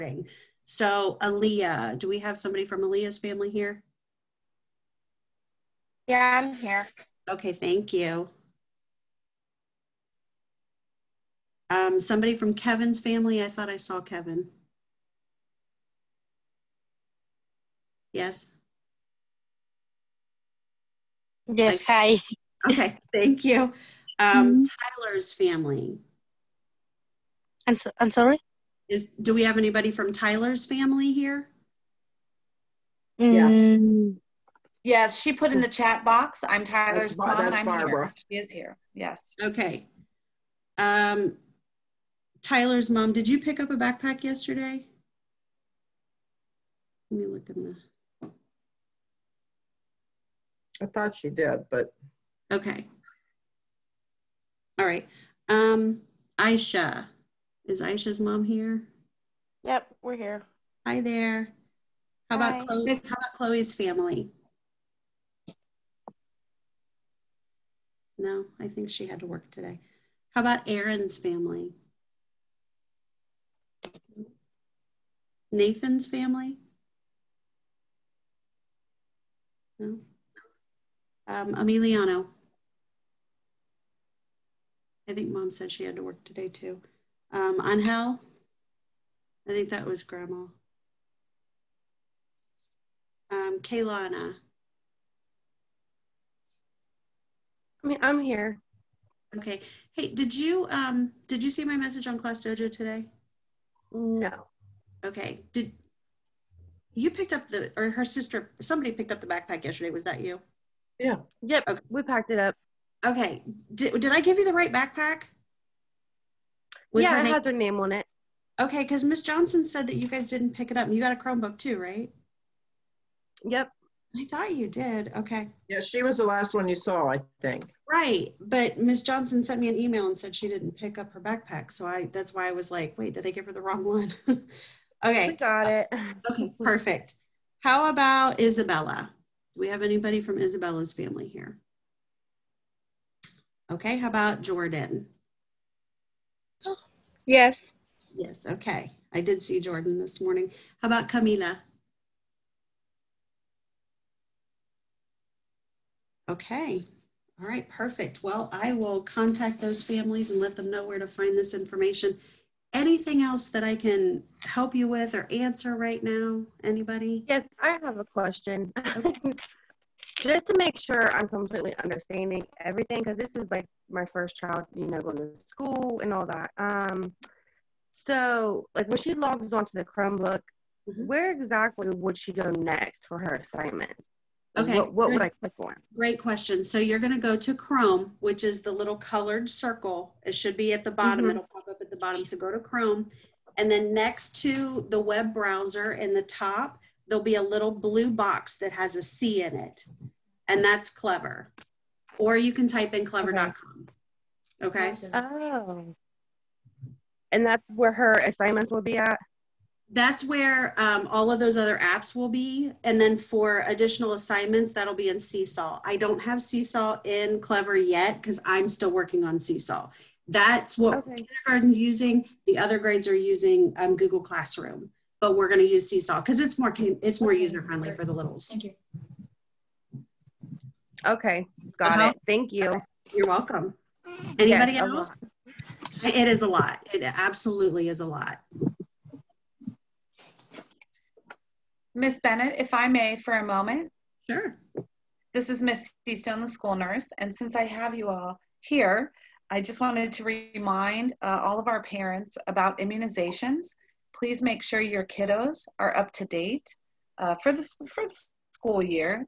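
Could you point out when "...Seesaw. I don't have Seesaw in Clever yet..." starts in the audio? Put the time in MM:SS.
03:35.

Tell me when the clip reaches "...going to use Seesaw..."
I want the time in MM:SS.
03:45.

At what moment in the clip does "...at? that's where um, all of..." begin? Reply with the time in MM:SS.
03:28.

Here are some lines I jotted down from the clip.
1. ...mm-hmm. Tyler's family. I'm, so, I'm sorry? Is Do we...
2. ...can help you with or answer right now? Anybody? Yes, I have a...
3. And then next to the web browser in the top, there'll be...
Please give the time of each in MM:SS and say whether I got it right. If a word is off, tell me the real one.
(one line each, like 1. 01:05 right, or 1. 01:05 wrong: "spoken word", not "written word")
1. 00:24 right
2. 02:43 right
3. 03:13 right.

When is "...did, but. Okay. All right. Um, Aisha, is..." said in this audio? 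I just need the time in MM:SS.
00:51.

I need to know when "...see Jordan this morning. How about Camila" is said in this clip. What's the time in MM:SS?
02:29.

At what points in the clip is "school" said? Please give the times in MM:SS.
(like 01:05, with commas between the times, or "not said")
02:55, 04:06, 04:18.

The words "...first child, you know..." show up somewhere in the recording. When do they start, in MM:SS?
02:54.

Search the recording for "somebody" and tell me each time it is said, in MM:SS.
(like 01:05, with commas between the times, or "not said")
00:02, 00:12, 01:48.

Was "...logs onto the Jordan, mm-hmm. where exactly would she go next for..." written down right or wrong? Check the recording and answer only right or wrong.
wrong.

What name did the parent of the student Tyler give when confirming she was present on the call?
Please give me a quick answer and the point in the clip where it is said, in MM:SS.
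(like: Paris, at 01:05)
Barbara, at 00:37.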